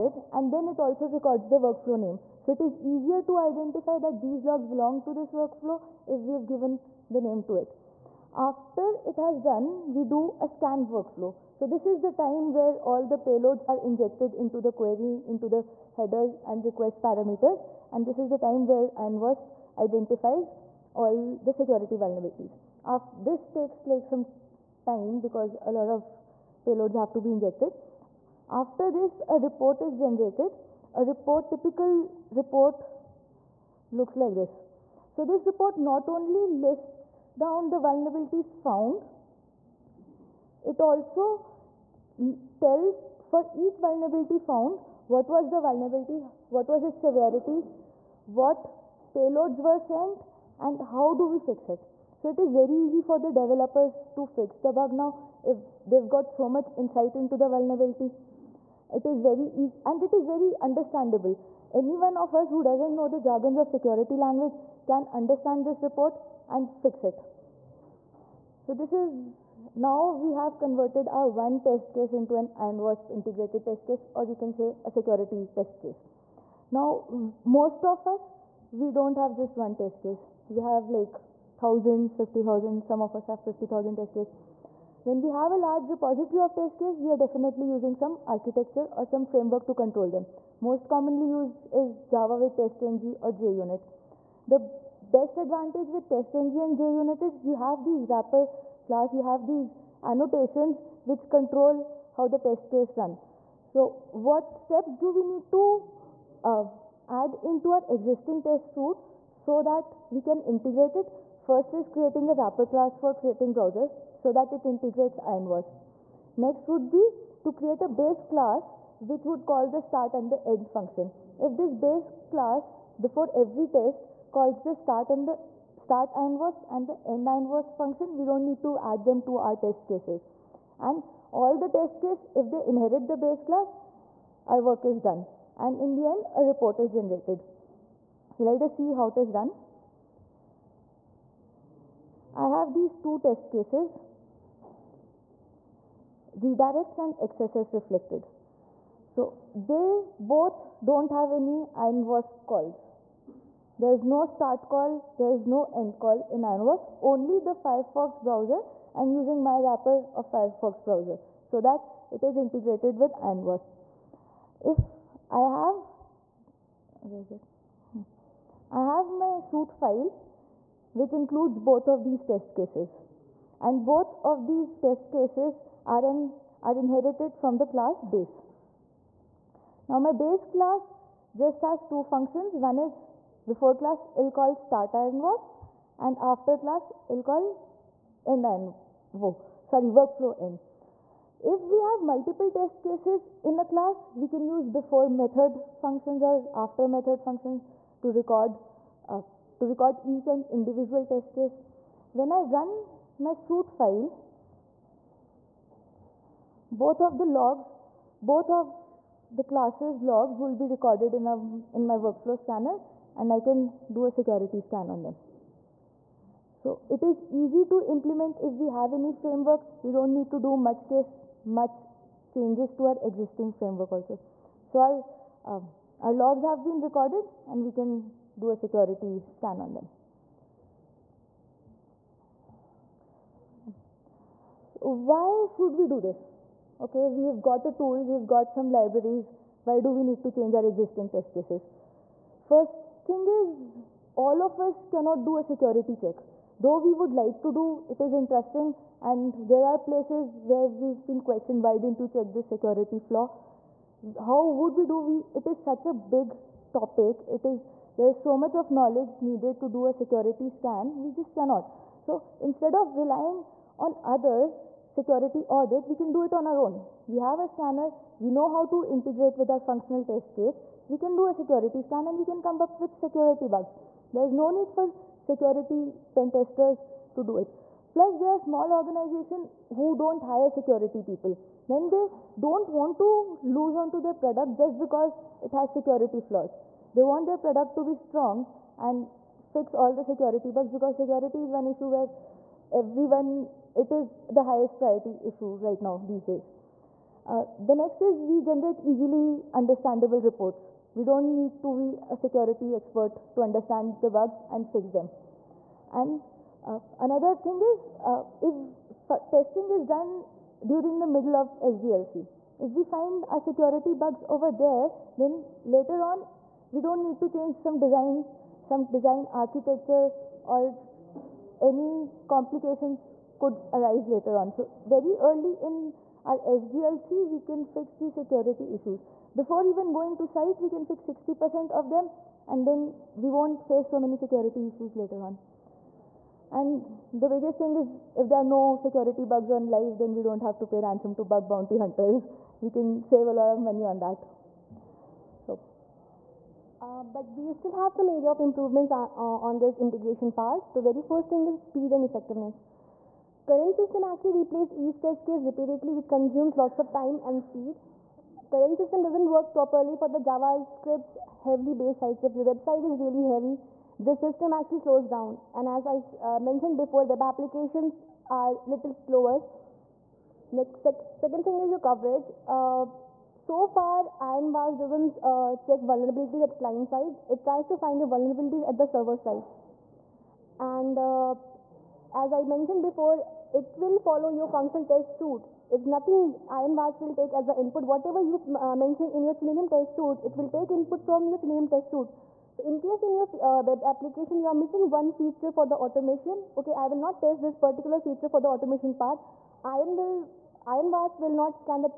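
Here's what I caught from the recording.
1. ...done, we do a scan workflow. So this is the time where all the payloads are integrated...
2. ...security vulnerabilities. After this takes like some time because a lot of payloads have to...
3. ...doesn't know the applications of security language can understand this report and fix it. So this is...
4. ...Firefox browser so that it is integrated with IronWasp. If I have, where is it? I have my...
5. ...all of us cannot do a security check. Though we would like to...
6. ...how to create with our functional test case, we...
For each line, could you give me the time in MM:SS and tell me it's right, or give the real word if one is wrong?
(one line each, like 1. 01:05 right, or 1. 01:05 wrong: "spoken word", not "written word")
1. 00:09 wrong: "injected", not "integrated"
2. 00:21 right
3. 01:02 wrong: "jargons", not "applications"
4. 02:40 right
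5. 04:04 right
6. 04:28 wrong: "integrate", not "create".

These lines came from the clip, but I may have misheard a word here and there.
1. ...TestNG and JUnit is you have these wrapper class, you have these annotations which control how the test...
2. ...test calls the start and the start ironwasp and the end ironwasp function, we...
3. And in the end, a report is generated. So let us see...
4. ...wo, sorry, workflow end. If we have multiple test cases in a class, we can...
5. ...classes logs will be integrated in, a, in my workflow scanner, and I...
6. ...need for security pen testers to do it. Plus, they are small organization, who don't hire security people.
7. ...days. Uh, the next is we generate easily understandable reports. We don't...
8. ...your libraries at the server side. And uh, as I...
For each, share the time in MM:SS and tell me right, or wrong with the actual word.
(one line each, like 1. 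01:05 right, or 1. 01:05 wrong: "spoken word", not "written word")
1. 01:36 right
2. 02:03 right
3. 02:15 right
4. 03:09 right
5. 03:29 wrong: "recorded", not "integrated"
6. 04:34 right
7. 04:56 right
8. 06:17 wrong: "vulnerabilities", not "libraries".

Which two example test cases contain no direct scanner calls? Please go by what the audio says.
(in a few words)
redirects and XSS reflected.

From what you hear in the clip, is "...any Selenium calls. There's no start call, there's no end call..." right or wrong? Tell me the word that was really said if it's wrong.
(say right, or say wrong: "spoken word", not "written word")
wrong: "IronWasp", not "Selenium".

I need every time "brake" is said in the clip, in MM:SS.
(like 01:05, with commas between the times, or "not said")
not said.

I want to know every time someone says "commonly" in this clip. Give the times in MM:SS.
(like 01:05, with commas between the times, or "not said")
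01:30.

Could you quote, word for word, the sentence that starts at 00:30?
A report, typical report looks like this.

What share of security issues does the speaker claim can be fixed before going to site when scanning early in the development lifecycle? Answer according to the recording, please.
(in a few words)
60%.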